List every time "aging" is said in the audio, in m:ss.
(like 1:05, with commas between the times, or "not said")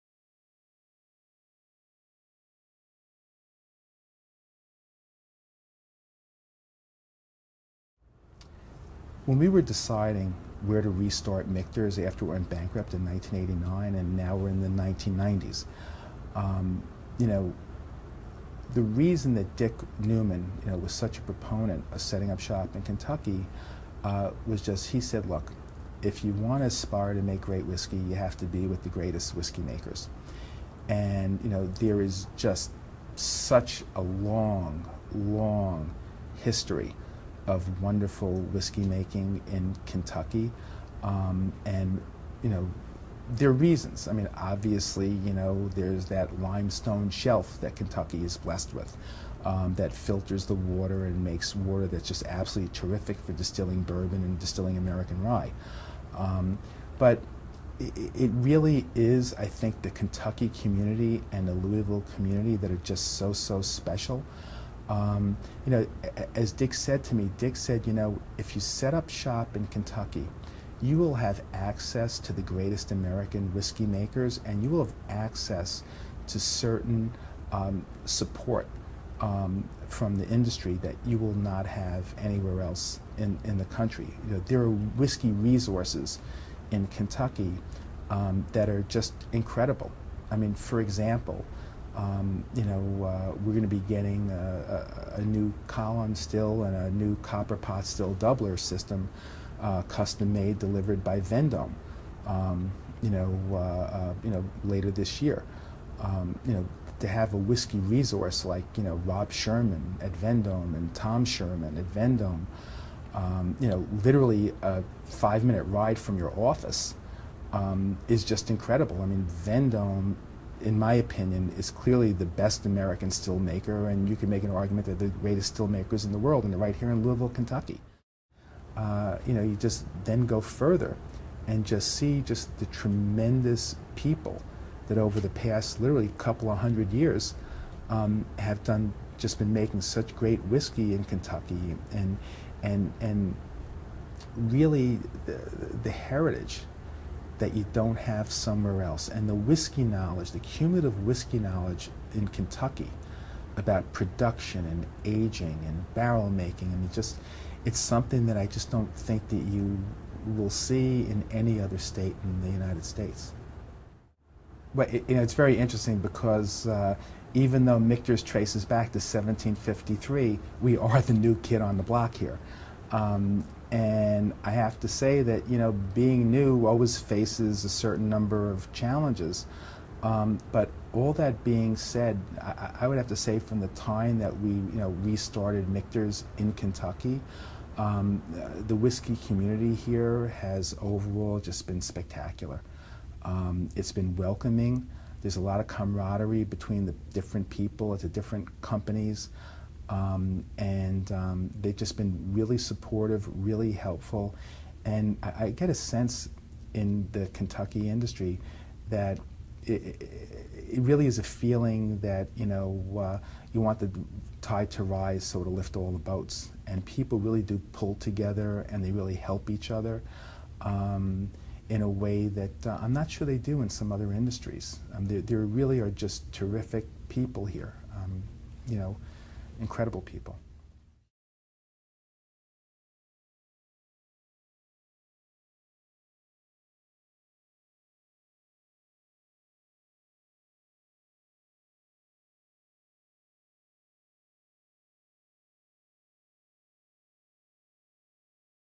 2:35.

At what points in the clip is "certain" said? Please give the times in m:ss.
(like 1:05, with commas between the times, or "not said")
1:16, 2:57.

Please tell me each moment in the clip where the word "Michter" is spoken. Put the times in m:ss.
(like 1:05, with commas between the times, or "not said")
0:11, 2:47, 3:05.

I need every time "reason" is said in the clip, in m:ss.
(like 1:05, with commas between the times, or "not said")
0:18, 0:43.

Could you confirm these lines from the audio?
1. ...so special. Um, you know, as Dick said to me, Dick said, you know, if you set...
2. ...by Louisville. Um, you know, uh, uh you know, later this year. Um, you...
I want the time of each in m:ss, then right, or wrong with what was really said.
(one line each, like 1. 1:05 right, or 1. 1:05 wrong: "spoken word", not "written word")
1. 1:03 right
2. 1:41 wrong: "Vendome", not "Louisville".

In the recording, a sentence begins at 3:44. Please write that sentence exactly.
Um, there, there really are just terrific people here.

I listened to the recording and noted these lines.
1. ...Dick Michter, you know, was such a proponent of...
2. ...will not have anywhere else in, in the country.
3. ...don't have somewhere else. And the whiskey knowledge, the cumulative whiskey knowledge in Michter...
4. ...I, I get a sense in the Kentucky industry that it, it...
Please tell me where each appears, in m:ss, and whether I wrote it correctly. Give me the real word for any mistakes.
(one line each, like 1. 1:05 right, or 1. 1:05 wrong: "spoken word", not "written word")
1. 0:19 wrong: "Newman", not "Michter"
2. 1:21 right
3. 2:27 wrong: "Kentucky", not "Michter"
4. 3:25 right.